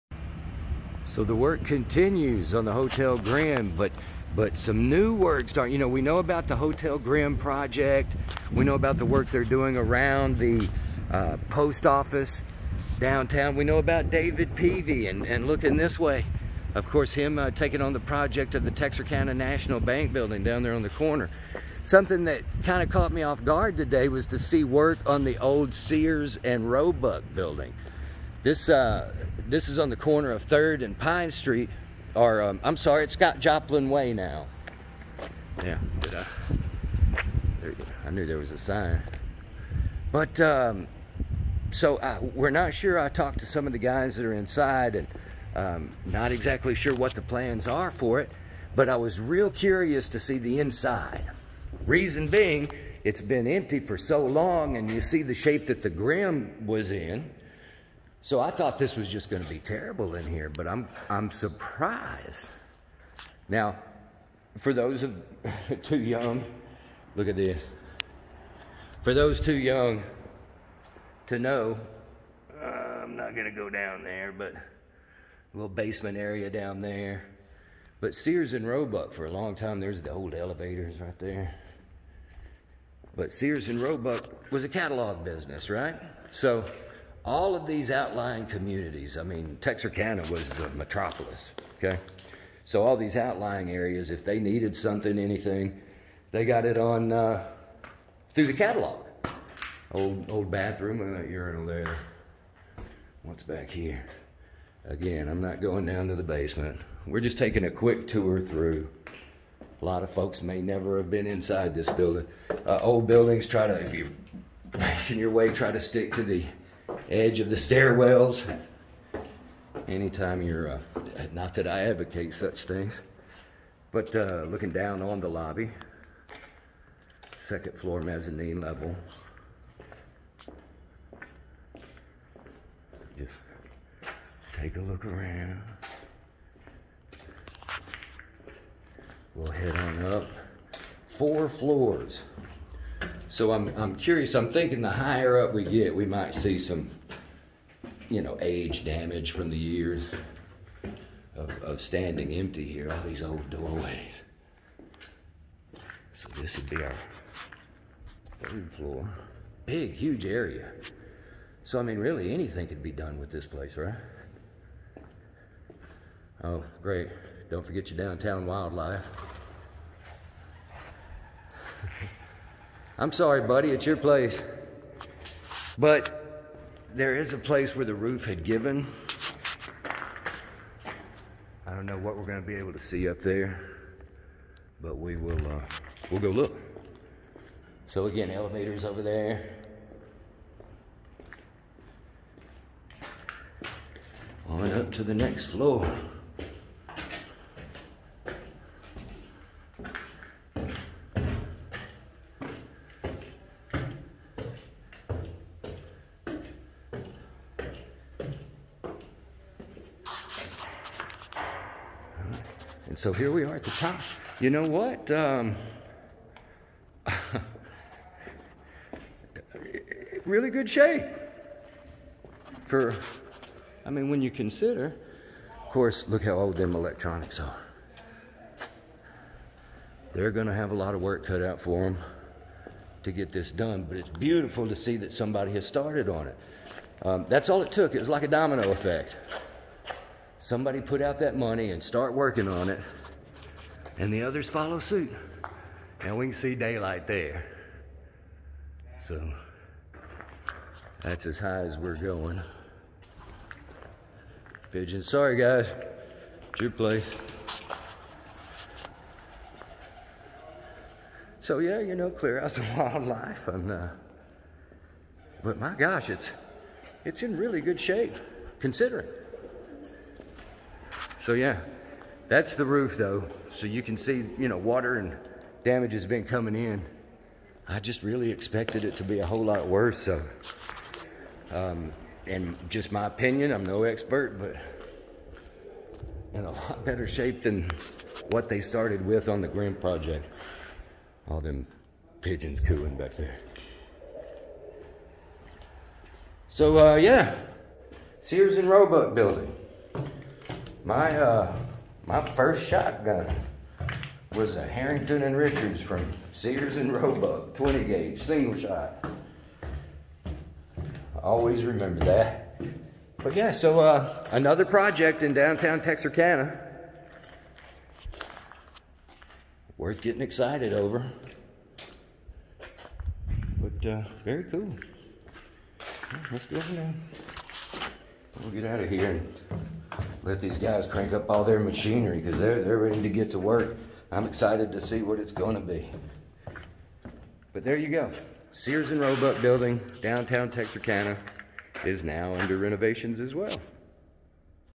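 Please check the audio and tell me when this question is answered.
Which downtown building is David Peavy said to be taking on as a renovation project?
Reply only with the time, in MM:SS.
00:18.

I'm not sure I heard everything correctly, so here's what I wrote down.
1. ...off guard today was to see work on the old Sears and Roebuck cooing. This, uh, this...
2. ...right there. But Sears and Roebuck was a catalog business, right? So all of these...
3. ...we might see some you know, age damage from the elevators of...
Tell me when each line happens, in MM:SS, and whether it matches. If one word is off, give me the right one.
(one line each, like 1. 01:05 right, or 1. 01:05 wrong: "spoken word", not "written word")
1. 00:23 wrong: "building", not "cooing"
2. 01:20 right
3. 02:25 wrong: "years", not "elevators".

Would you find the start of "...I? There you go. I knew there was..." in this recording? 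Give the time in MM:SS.
00:36.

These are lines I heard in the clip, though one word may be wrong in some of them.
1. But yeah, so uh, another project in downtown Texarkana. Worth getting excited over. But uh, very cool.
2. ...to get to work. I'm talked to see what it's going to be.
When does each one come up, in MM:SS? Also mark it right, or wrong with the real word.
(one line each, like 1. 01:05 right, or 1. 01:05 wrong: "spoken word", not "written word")
1. 05:13 right
2. 05:33 wrong: "excited", not "talked".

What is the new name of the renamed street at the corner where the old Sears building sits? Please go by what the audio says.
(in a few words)
Scott Joplin Way.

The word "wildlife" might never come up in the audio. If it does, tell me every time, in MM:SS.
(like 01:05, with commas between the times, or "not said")
02:48, 04:22.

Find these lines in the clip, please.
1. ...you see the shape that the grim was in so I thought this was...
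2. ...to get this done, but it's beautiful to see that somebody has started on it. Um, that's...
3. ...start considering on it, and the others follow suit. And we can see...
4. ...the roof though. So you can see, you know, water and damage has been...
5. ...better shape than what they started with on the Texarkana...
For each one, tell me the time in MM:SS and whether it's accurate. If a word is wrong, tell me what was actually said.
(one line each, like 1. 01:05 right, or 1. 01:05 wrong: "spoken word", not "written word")
1. 00:54 right
2. 03:53 right
3. 04:01 wrong: "working", not "considering"
4. 04:32 right
5. 04:46 wrong: "Grim", not "Texarkana".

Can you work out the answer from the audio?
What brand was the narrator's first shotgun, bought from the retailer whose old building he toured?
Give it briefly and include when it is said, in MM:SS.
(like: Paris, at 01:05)
Harrington and Richards, at 05:04.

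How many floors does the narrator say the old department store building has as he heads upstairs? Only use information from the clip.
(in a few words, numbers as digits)
4.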